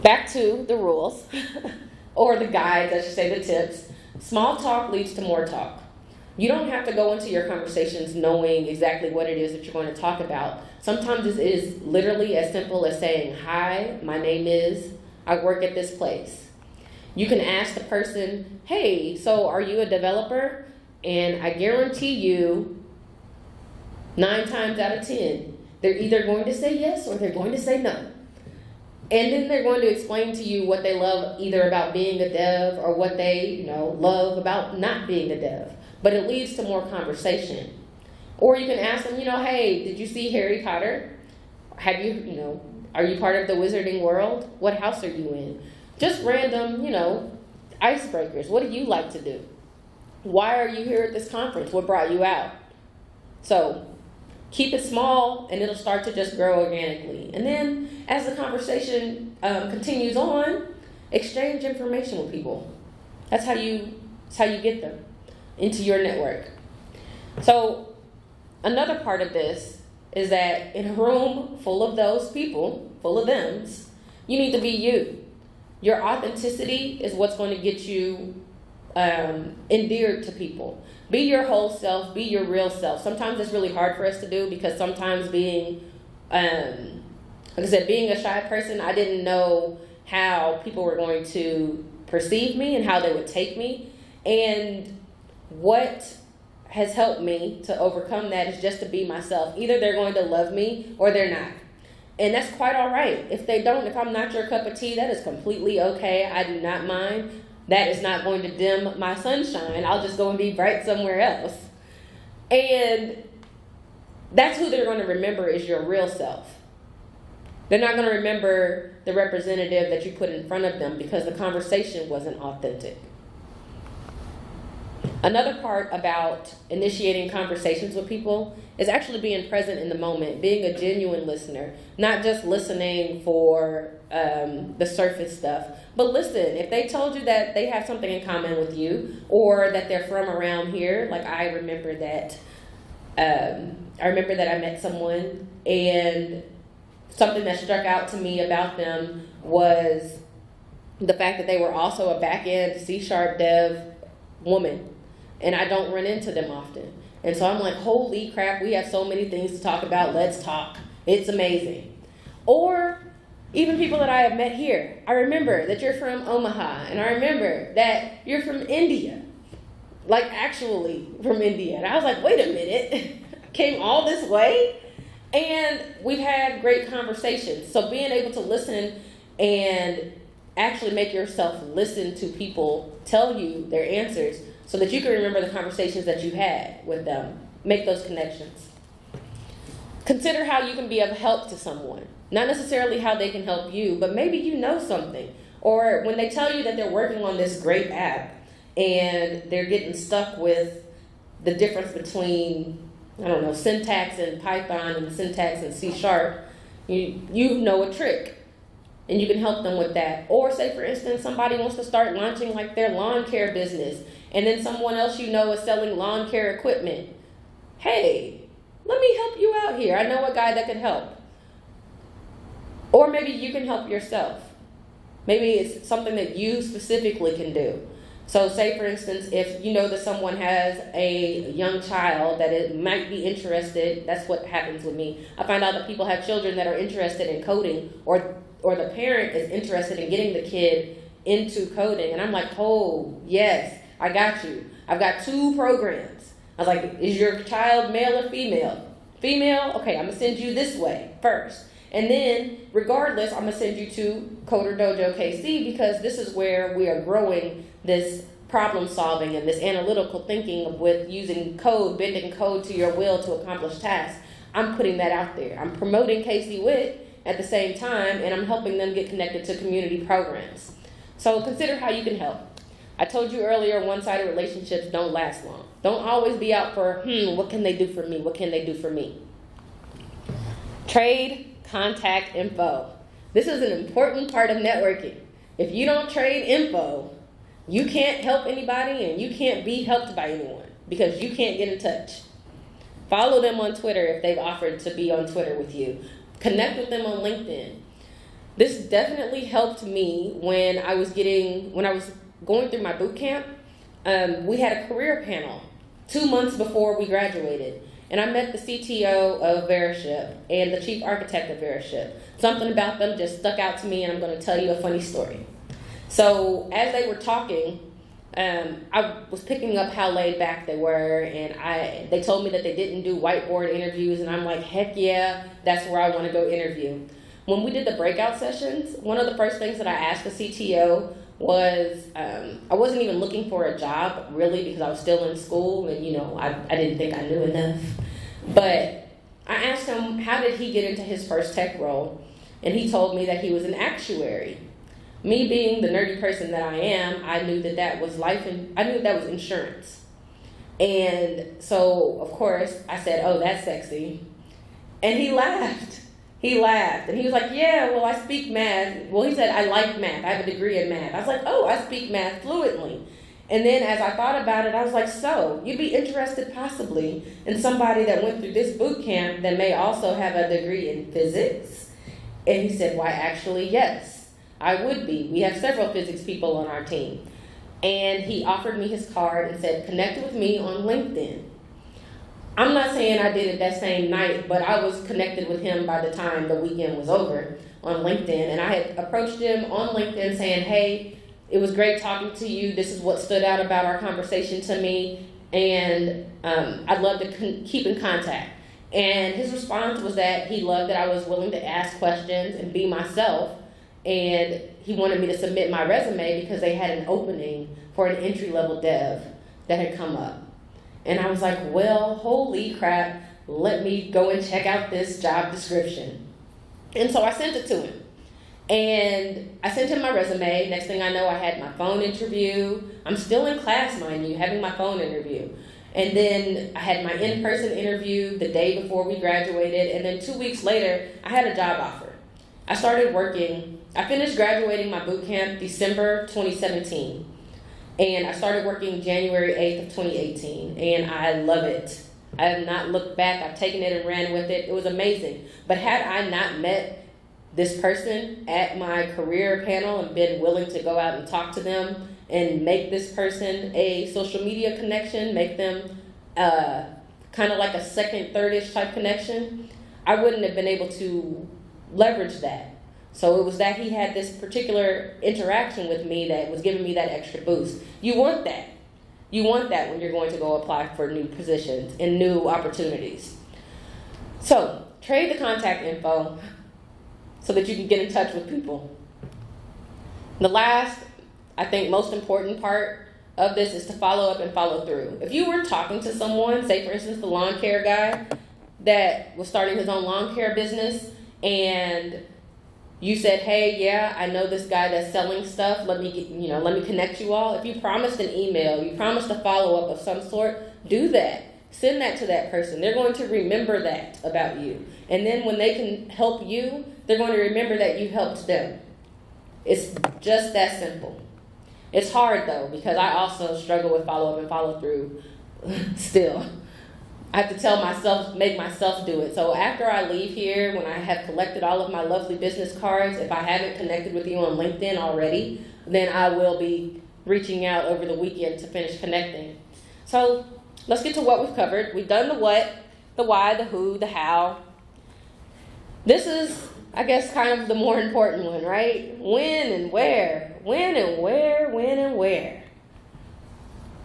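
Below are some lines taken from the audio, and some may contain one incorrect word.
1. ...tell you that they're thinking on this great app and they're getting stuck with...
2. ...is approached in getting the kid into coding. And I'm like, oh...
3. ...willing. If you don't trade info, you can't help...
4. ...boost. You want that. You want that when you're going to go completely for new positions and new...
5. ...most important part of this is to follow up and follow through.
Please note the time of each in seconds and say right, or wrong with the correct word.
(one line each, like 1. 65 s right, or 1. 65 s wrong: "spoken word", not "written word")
1. 196 s wrong: "working", not "thinking"
2. 239 s wrong: "interested", not "approached"
3. 284 s wrong: "networking", not "willing"
4. 467 s wrong: "apply", not "completely"
5. 481 s right.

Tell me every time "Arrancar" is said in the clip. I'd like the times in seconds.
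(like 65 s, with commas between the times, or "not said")
not said.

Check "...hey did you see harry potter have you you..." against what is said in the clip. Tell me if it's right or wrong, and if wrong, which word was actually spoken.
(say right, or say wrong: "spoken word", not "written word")
right.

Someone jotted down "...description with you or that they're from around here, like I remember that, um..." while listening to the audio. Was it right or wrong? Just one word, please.
wrong.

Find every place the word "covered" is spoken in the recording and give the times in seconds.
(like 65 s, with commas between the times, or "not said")
531 s.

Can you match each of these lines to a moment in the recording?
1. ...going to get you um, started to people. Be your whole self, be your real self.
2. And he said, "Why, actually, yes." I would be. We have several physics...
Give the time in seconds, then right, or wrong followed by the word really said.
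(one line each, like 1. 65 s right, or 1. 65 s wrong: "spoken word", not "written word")
1. 77 s wrong: "endeared", not "started"
2. 372 s right.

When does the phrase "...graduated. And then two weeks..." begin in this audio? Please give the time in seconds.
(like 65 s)
429 s.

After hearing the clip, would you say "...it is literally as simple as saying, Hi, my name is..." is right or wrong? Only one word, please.
right.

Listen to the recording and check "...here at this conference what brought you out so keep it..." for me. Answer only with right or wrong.
right.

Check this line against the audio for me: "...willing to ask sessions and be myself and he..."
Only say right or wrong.
wrong.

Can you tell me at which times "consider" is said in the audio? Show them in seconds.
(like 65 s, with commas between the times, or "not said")
190 s, 271 s.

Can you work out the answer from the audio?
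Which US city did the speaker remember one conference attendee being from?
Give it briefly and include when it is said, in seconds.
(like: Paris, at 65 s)
Omaha, at 166 s.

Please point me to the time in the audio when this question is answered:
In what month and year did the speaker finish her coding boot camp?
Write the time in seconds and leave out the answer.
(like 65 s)
435 s.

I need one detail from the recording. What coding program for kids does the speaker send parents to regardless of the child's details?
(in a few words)
Coder Dojo KC.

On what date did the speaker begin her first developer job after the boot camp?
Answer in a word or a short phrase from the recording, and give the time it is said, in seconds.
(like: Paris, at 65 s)
January 8, 2018, at 439 s.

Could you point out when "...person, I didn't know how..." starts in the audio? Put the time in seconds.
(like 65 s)
88 s.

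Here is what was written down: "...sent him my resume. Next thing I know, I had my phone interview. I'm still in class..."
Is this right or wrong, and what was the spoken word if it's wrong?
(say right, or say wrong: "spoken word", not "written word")
right.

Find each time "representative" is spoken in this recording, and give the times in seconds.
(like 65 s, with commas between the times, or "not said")
119 s.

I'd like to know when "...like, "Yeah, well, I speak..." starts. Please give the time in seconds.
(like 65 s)
357 s.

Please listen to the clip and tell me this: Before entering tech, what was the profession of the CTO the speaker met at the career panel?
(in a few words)
Actuary.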